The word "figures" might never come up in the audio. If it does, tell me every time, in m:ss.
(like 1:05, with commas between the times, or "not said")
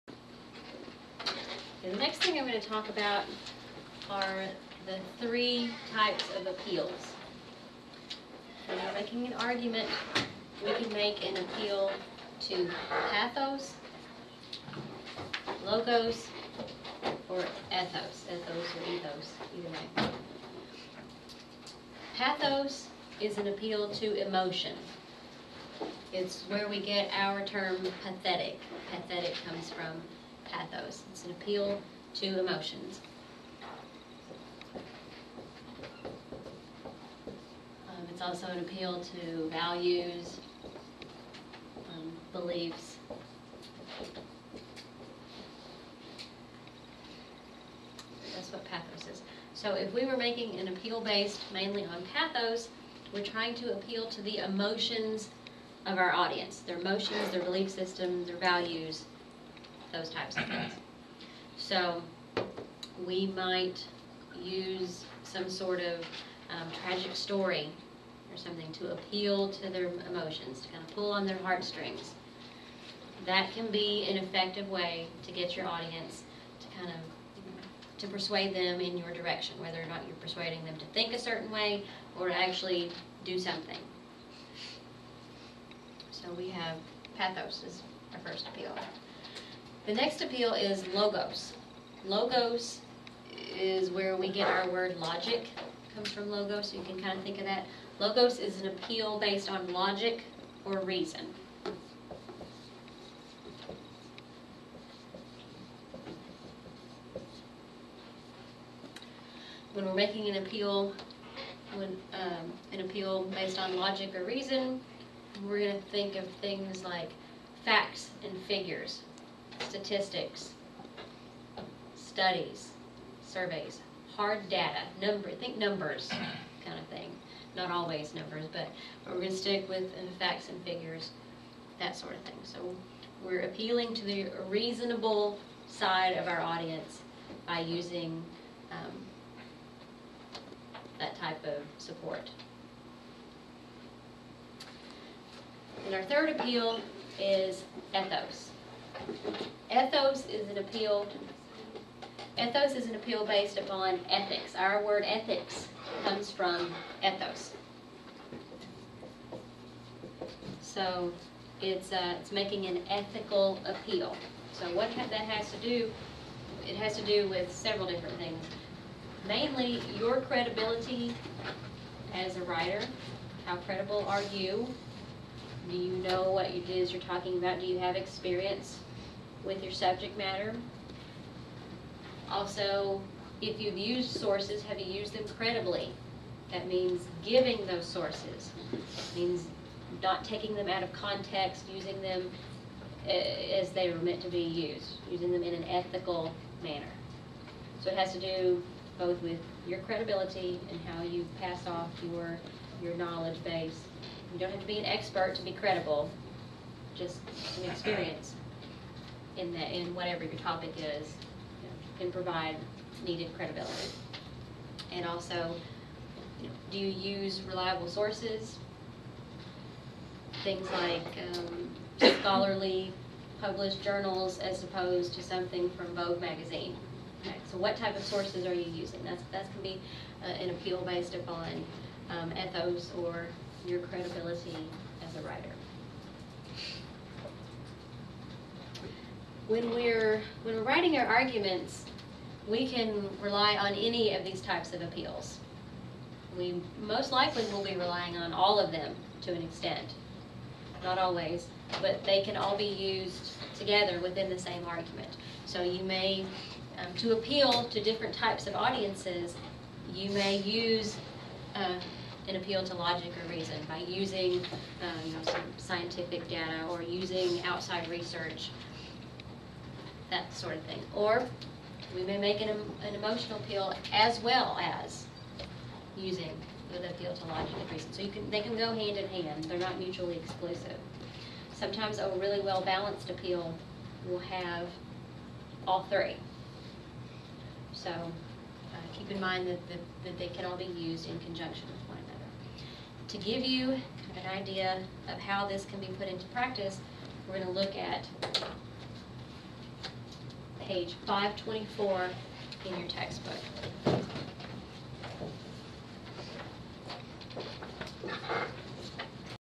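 1:58, 2:10.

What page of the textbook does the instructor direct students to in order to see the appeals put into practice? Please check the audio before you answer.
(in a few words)
524.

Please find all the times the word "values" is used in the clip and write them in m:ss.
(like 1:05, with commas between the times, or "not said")
0:39, 0:58.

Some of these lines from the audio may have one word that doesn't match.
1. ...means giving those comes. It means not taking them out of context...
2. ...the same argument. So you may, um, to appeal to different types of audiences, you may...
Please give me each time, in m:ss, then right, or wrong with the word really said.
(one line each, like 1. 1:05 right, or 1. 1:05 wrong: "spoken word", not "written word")
1. 3:06 wrong: "sources", not "comes"
2. 4:14 right.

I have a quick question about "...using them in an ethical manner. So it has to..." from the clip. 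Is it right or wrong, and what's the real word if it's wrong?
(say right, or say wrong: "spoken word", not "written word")
right.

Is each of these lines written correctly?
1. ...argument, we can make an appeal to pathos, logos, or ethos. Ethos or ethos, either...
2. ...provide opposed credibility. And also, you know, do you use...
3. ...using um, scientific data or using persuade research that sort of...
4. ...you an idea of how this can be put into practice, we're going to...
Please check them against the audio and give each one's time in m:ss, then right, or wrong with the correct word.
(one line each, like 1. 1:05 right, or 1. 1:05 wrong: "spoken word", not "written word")
1. 0:09 right
2. 3:32 wrong: "needed", not "opposed"
3. 4:23 wrong: "outside", not "persuade"
4. 4:53 right.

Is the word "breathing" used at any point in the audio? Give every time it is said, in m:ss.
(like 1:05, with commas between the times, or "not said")
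not said.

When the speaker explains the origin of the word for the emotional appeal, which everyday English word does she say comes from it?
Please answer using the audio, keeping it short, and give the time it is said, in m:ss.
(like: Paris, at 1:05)
pathetic, at 0:26.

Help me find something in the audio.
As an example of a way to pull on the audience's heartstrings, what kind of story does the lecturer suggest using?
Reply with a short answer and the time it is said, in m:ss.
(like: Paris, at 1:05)
tragic story, at 1:06.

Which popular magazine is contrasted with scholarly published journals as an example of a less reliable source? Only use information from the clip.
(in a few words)
Vogue.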